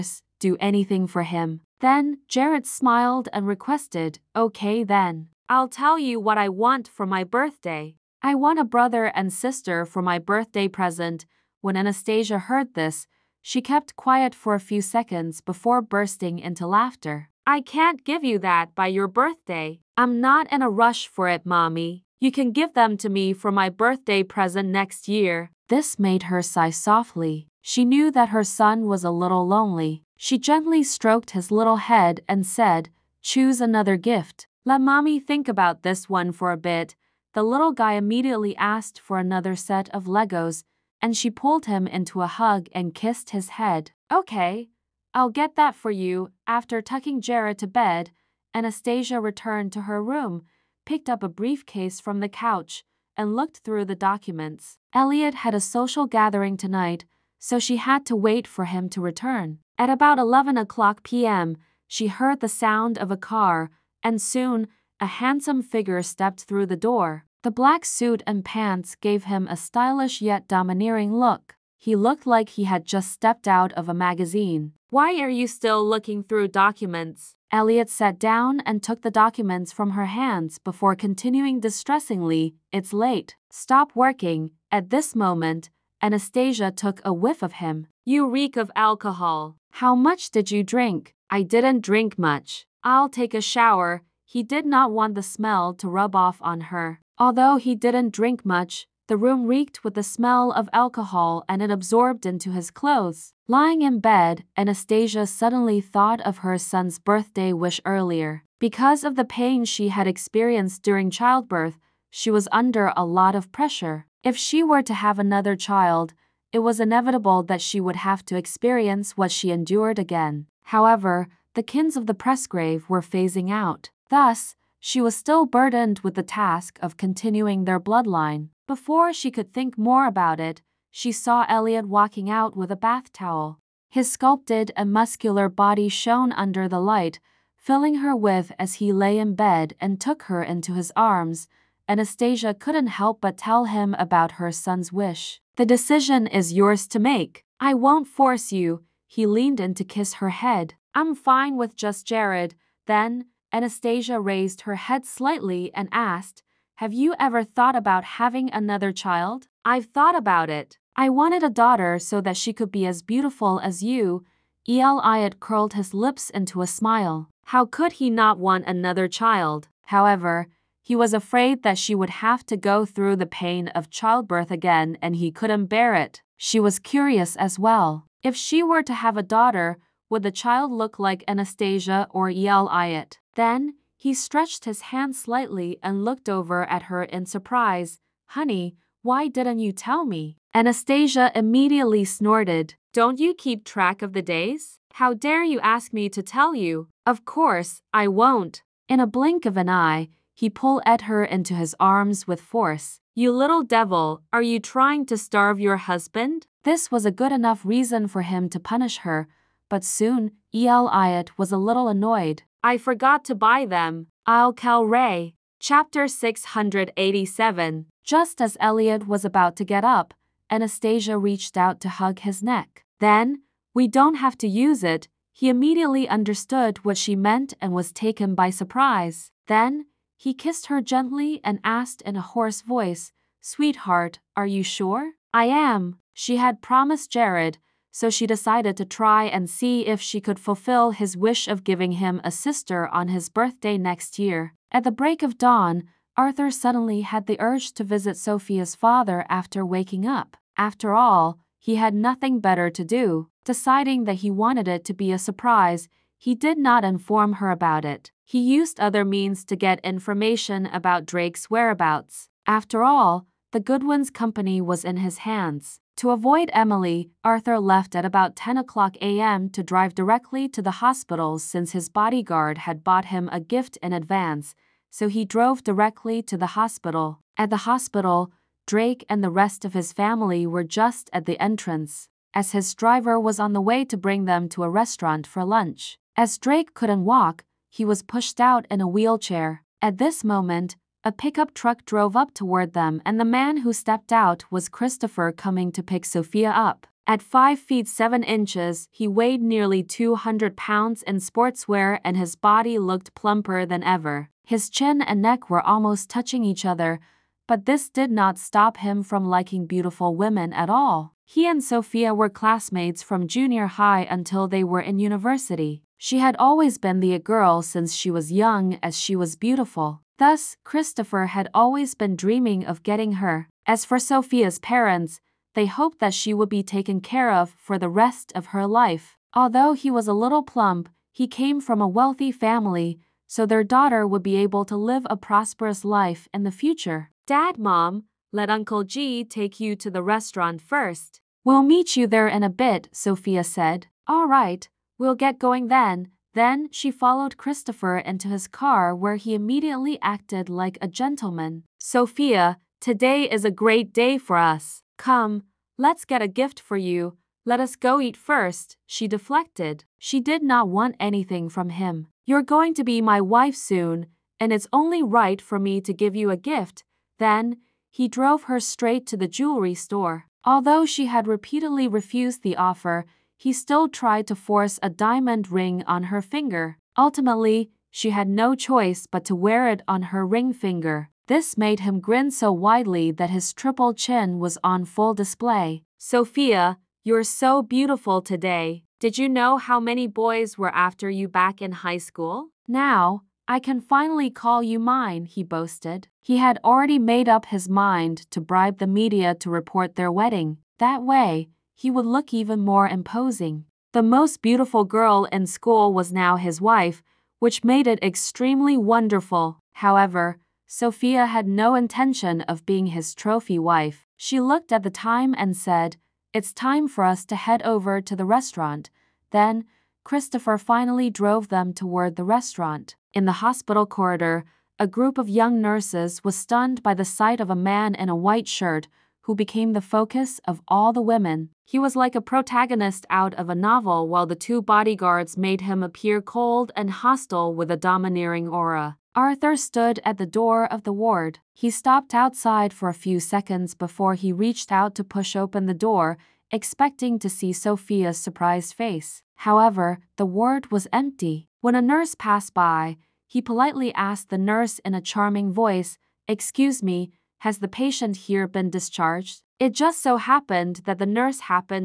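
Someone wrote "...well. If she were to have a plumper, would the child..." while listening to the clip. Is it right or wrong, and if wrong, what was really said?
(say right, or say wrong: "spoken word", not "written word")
wrong: "daughter", not "plumper".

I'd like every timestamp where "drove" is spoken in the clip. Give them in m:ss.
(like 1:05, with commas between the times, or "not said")
4:35, 4:51, 6:08, 7:01.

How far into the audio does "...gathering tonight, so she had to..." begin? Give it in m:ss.
0:56.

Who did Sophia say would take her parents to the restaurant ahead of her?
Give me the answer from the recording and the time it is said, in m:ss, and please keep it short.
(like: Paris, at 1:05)
Uncle G, at 5:38.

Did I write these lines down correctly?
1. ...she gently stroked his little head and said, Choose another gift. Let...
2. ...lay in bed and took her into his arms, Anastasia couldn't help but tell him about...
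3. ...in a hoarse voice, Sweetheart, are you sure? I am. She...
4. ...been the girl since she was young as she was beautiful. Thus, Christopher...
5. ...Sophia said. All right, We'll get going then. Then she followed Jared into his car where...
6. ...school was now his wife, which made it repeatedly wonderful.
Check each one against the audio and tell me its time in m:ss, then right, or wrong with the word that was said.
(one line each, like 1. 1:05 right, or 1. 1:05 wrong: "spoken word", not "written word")
1. 0:30 right
2. 2:18 right
3. 3:52 right
4. 5:16 right
5. 5:42 wrong: "Christopher", not "Jared"
6. 6:45 wrong: "extremely", not "repeatedly".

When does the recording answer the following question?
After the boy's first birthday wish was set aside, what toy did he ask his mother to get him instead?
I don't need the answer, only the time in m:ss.
0:39.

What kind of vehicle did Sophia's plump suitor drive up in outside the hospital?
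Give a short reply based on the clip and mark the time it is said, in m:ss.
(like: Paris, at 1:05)
Pickup truck, at 4:51.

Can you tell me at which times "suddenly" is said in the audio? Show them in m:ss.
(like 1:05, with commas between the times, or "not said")
1:45, 4:06.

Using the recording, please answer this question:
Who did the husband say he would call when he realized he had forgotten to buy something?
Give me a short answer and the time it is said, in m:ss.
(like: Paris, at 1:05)
Ray, at 3:34.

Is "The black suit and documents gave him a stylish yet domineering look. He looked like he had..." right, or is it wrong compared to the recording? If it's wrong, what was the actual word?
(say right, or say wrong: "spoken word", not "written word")
wrong: "pants", not "documents".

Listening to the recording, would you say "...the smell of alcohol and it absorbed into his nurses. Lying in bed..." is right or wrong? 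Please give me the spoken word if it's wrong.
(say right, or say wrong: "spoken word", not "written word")
wrong: "clothes", not "nurses".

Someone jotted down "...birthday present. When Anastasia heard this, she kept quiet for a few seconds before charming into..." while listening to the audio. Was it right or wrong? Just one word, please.
wrong.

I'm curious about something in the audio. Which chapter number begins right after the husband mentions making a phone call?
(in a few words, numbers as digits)
687.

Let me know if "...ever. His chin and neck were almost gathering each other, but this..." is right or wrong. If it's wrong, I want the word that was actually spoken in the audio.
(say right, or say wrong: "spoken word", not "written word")
wrong: "touching", not "gathering".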